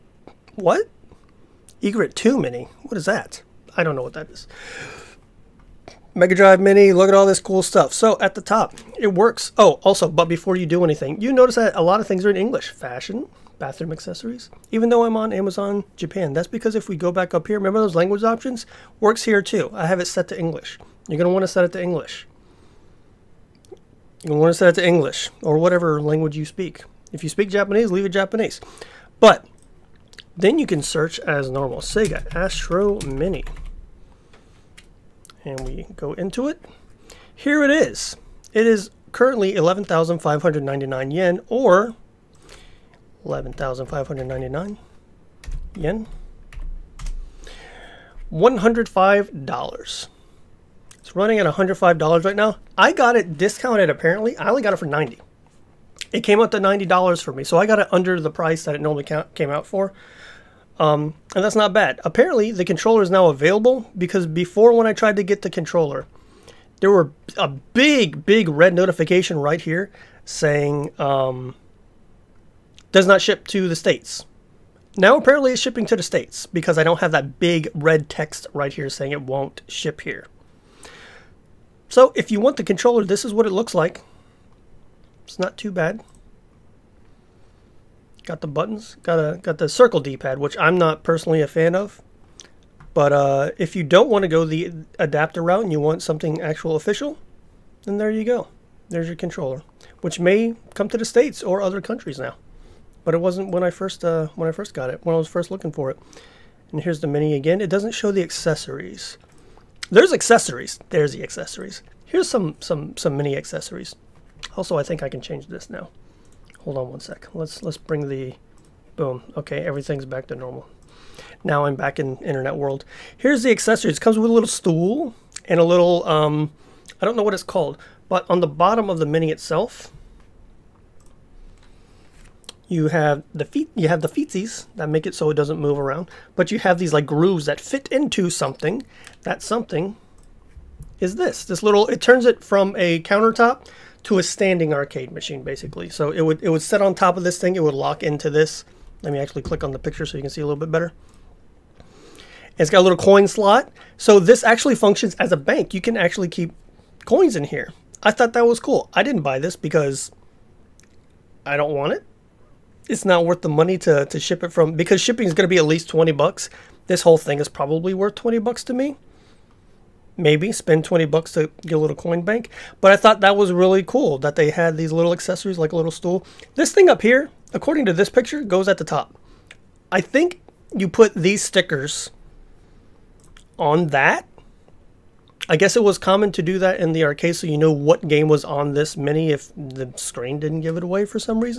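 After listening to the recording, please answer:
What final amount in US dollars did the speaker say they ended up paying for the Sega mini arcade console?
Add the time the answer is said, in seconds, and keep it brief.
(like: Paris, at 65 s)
$90, at 56 s.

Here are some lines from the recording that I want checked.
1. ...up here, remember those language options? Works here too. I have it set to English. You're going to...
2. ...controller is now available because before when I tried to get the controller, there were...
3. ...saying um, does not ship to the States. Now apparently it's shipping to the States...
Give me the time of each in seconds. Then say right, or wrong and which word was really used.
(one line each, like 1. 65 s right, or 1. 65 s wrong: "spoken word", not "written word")
1. 17 s right
2. 62 s right
3. 70 s right.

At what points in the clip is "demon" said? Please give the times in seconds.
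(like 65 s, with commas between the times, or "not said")
not said.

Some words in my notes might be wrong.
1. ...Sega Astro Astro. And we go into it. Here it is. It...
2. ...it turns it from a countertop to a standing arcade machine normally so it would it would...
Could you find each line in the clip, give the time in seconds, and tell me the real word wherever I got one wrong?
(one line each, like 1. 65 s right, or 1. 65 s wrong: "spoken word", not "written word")
1. 31 s wrong: "Mini", not "Astro"
2. 141 s wrong: "basically", not "normally".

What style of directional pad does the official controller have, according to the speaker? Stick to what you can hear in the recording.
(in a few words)
circle D-pad.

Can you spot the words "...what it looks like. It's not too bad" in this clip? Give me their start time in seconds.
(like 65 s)
83 s.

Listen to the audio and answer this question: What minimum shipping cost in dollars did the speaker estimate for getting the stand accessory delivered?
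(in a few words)
20 bucks.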